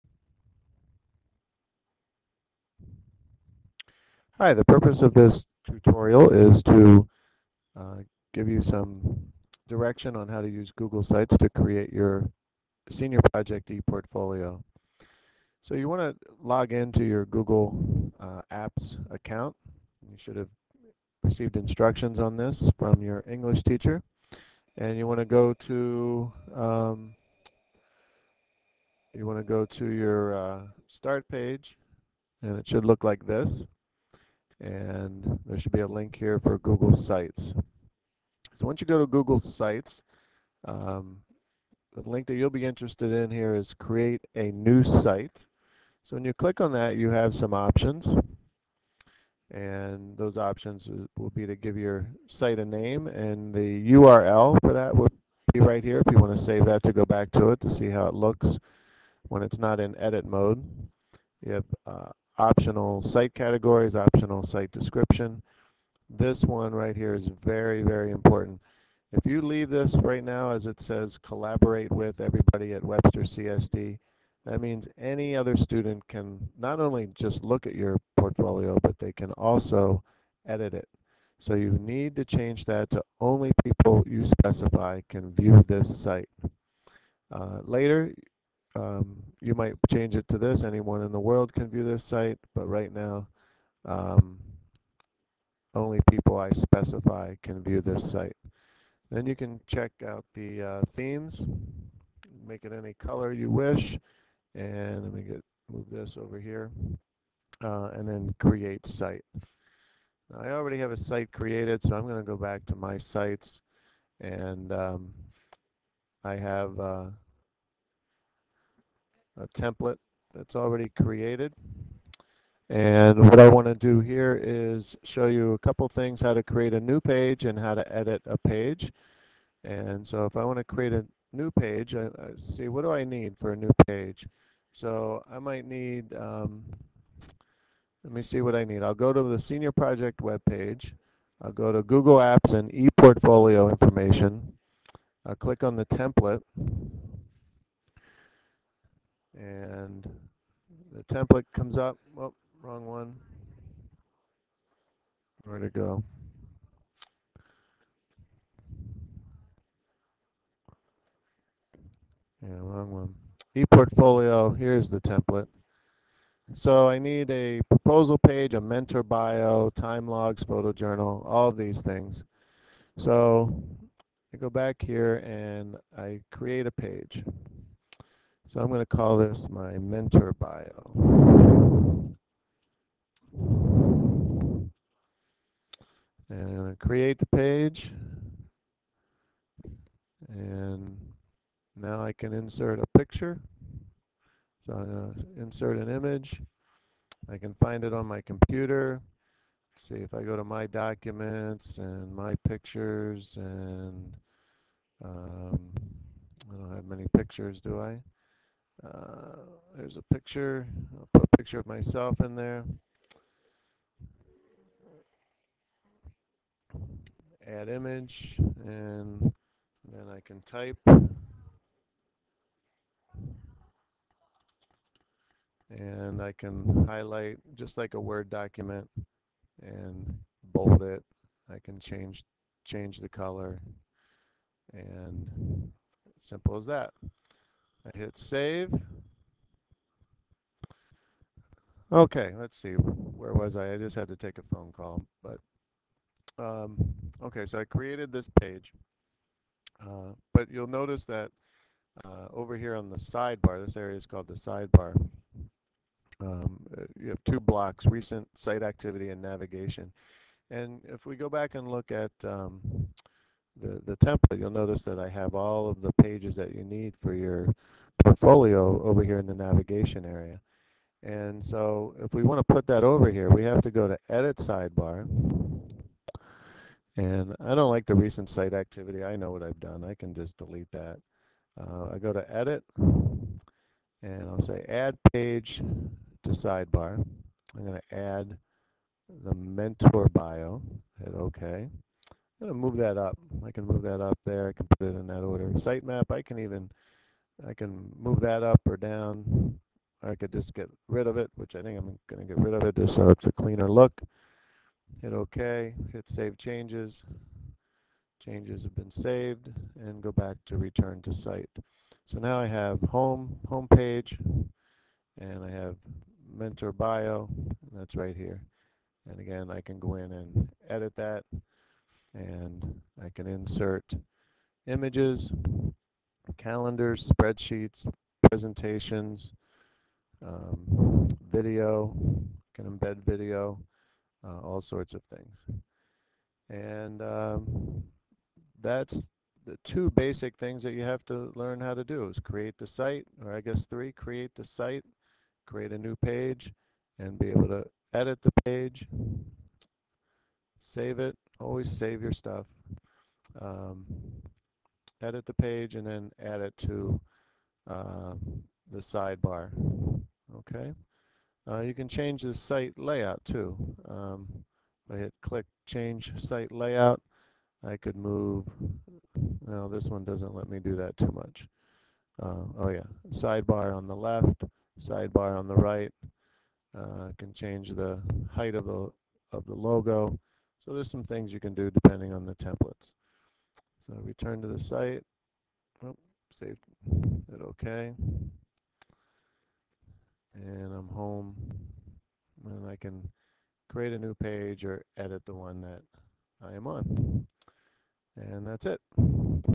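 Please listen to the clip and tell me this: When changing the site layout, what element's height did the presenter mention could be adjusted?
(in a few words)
The logo.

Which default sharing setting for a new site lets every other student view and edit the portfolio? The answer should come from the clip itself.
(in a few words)
Collaborate with everybody at Webster CSD.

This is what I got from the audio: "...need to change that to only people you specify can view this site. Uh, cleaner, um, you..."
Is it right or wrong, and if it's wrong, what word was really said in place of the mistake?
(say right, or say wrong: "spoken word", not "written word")
wrong: "later", not "cleaner".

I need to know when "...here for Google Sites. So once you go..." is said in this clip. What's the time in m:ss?
0:36.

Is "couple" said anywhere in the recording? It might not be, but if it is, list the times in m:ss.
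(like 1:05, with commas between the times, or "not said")
2:05.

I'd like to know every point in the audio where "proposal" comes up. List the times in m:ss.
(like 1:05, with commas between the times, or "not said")
2:47.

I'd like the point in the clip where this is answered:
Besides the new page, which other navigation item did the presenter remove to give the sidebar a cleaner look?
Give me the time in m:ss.
4:55.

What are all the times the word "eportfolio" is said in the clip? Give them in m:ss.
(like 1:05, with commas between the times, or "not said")
0:13, 2:22, 2:43.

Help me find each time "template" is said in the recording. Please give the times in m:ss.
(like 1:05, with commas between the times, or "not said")
1:59, 2:25, 2:31, 2:45, 4:23, 6:22.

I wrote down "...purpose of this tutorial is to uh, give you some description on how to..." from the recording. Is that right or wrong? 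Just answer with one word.
wrong.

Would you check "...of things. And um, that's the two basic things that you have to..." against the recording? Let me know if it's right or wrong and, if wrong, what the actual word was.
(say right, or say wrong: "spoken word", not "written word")
right.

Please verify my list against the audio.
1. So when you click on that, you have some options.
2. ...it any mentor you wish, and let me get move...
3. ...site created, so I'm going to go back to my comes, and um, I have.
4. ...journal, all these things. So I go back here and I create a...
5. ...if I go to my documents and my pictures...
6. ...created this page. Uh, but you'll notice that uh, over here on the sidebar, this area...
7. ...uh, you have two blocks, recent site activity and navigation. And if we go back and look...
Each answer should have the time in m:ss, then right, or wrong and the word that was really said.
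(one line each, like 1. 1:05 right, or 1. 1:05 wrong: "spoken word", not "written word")
1. 0:46 right
2. 1:42 wrong: "color", not "mentor"
3. 1:50 wrong: "sites", not "comes"
4. 2:50 right
5. 3:20 right
6. 4:07 right
7. 4:16 right.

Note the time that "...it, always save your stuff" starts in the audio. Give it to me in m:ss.
5:50.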